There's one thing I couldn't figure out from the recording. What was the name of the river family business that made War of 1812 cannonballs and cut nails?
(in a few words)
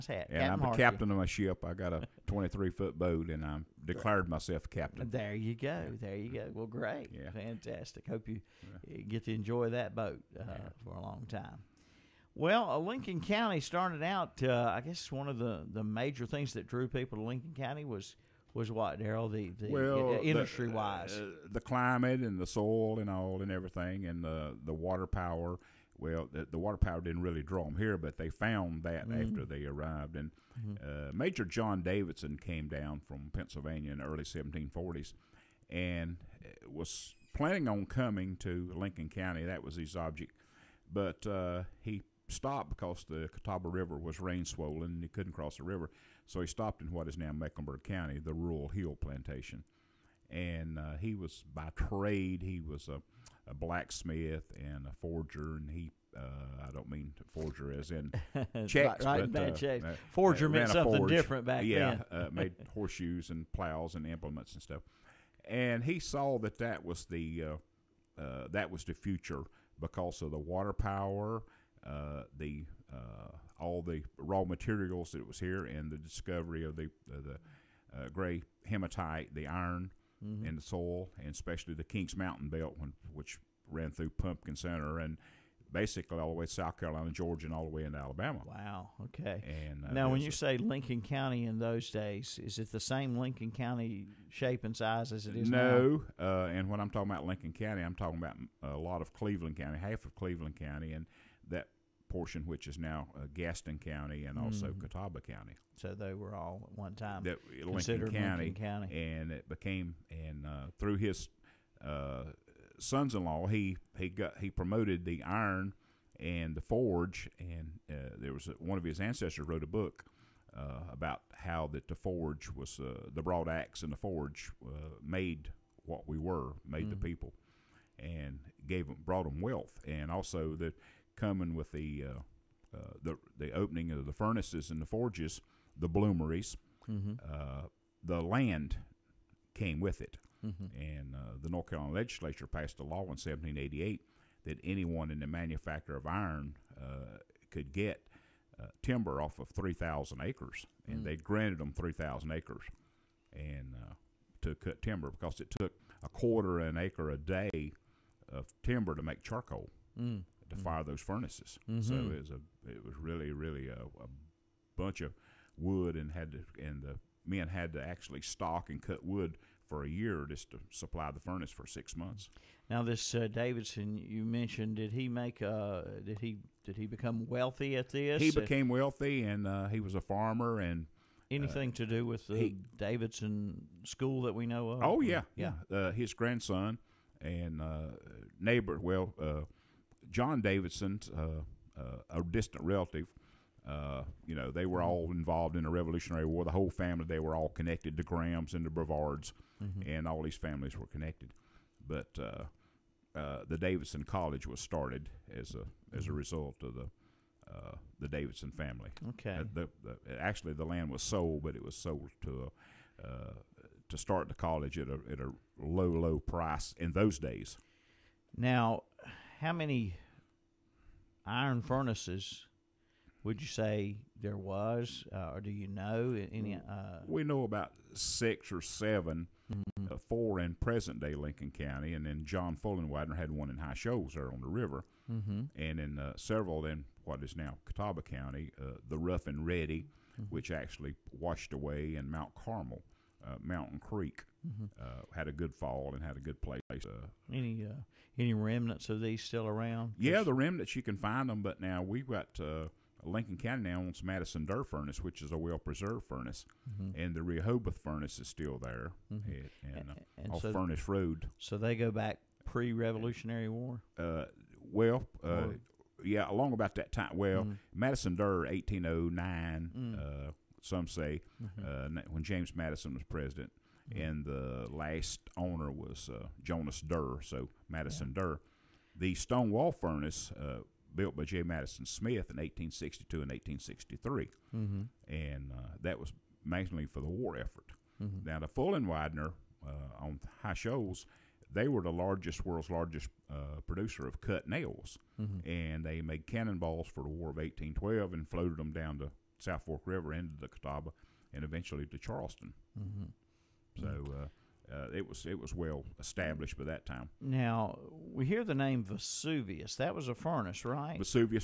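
Fullenwidener.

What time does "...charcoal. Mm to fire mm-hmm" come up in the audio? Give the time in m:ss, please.
2:39.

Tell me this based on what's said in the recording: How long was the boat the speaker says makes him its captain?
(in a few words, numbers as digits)
23 feet.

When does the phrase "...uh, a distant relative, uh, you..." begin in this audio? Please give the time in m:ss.
3:11.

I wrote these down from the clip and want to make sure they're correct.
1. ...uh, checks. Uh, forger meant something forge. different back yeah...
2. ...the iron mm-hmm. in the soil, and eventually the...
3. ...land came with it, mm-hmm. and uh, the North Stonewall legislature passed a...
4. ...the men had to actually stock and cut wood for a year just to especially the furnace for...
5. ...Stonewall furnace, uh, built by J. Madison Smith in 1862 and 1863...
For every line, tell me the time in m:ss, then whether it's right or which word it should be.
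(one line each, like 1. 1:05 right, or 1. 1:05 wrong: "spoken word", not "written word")
1. 0:59 right
2. 1:19 wrong: "especially", not "eventually"
3. 2:18 wrong: "Carolina", not "Stonewall"
4. 2:46 wrong: "supply", not "especially"
5. 4:39 right.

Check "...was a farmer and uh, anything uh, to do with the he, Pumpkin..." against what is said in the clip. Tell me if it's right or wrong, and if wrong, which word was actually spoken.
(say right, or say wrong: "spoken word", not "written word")
wrong: "Davidson", not "Pumpkin".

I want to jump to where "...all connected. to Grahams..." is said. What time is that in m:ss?
3:17.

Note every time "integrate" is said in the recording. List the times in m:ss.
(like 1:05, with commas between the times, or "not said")
not said.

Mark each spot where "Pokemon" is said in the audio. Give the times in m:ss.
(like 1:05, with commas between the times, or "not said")
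not said.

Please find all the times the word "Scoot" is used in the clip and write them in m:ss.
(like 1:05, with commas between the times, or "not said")
not said.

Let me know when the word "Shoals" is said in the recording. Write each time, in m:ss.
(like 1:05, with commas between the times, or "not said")
3:53, 4:50.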